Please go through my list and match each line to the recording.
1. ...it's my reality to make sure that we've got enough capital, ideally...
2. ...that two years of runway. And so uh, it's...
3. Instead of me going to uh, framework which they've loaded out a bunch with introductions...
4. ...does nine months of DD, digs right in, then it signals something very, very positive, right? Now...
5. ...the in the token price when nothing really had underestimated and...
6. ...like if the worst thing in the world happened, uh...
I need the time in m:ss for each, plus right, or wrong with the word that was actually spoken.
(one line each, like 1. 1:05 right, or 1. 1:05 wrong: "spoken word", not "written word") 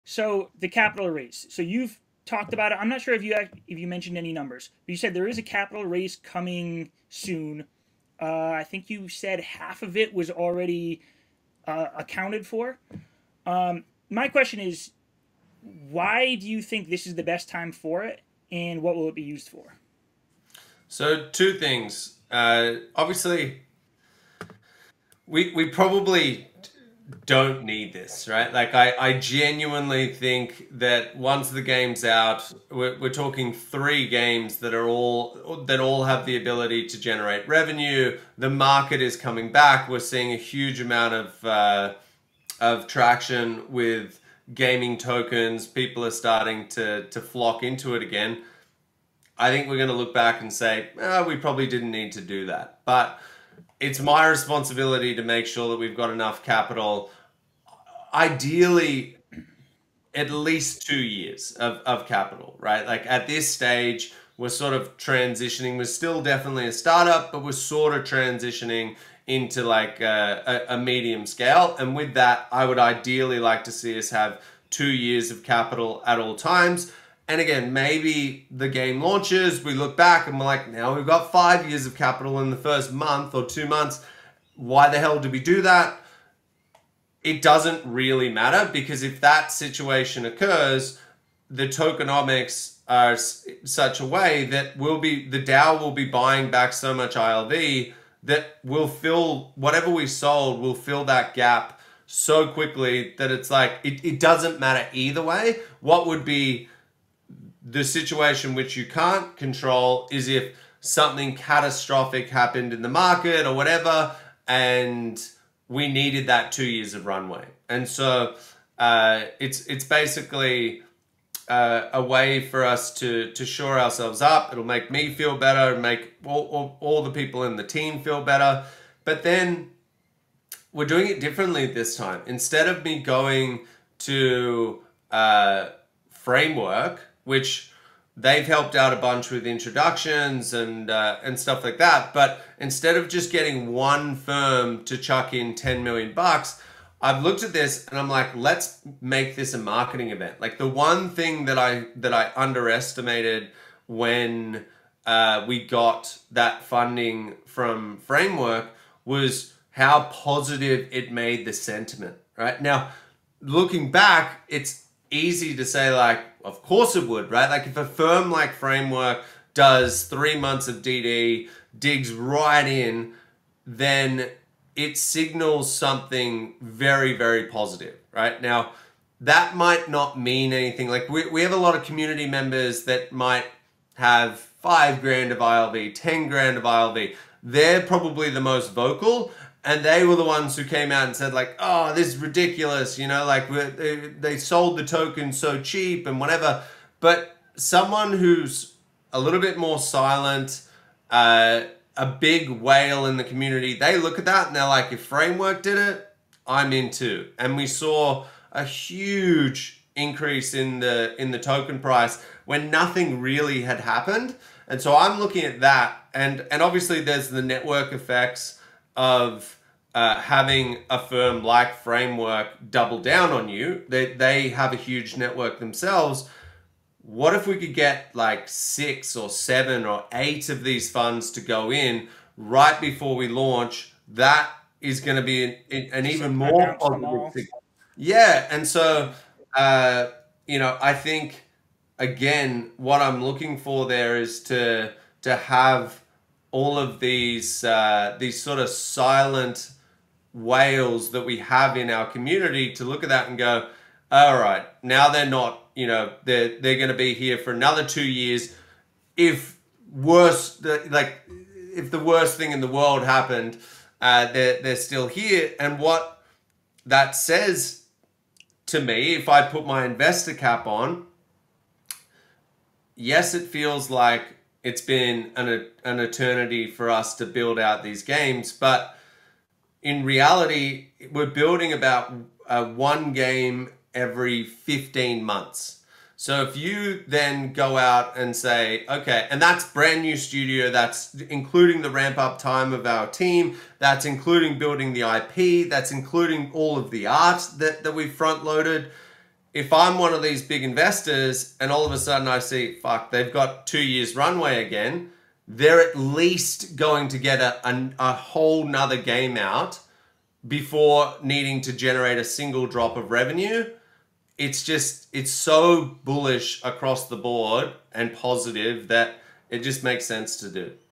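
1. 0:53 wrong: "responsibility", not "reality"
2. 1:56 right
3. 2:12 wrong: "helped", not "loaded"
4. 2:49 wrong: "three", not "nine"
5. 3:30 wrong: "happened", not "underestimated"
6. 4:20 right.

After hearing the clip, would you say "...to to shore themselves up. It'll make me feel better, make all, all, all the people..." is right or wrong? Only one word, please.
wrong.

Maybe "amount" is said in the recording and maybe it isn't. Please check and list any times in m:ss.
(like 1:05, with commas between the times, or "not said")
0:40.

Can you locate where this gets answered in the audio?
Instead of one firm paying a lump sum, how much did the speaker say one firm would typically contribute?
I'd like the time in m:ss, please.
2:25.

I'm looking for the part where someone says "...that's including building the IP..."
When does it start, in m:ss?
4:53.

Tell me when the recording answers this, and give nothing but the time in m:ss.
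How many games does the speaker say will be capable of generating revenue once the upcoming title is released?
0:33.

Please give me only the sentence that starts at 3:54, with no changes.
That is going to be an, an even more positive Yeah.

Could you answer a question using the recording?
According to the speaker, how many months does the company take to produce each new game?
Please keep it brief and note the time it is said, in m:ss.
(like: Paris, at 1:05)
15 months, at 4:44.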